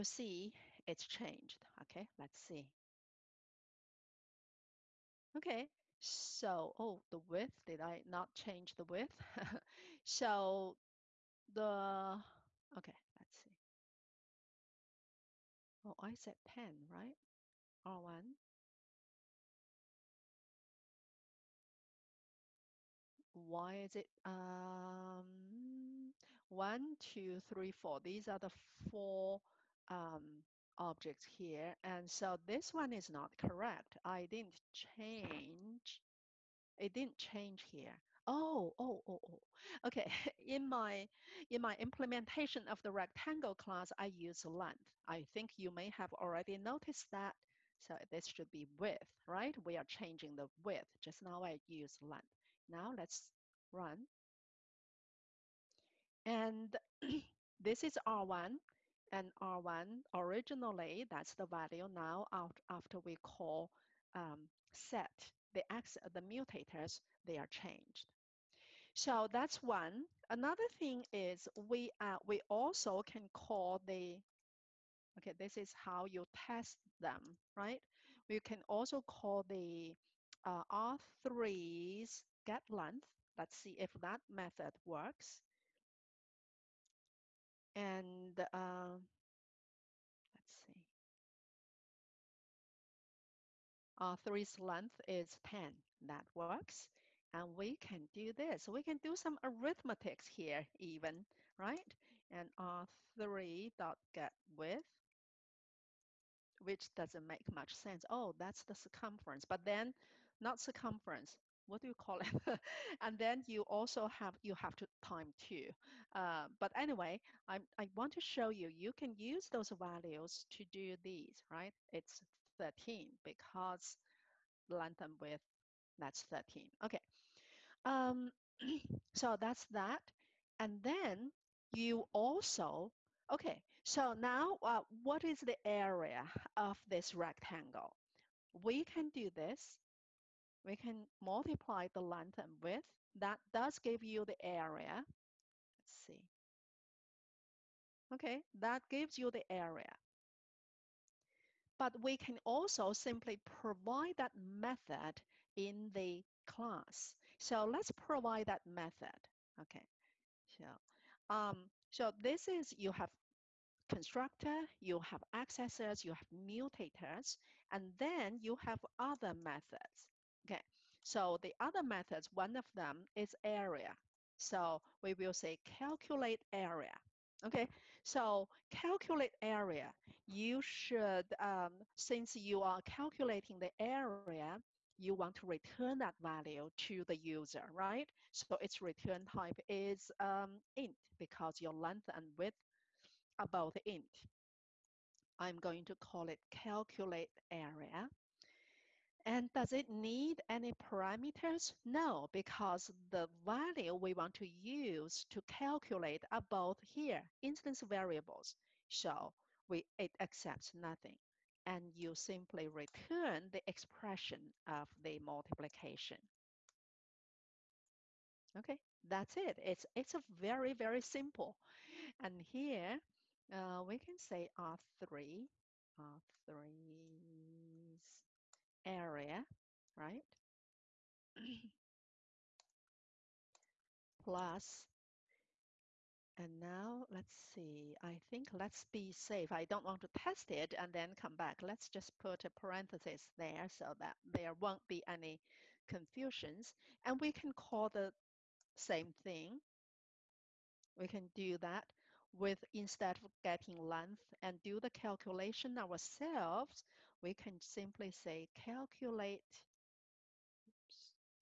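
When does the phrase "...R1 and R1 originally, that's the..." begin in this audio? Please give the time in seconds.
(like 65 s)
58 s.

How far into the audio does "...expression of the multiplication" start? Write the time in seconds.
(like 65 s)
213 s.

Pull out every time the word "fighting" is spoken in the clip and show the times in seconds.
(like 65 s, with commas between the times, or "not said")
not said.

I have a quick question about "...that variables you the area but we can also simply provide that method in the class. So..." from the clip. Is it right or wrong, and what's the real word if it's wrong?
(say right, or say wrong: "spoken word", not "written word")
wrong: "gives", not "variables".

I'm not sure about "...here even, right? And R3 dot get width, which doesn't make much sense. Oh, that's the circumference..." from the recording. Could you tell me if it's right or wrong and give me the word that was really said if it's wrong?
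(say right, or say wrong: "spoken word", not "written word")
right.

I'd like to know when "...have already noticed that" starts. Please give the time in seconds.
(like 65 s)
45 s.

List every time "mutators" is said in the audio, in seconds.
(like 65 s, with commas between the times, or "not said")
66 s, 166 s.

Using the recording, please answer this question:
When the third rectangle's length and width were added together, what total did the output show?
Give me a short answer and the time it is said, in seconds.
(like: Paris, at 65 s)
13, at 121 s.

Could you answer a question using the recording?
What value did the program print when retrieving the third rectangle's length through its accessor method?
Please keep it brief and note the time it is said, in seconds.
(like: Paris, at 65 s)
10, at 93 s.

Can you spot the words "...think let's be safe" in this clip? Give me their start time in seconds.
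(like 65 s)
238 s.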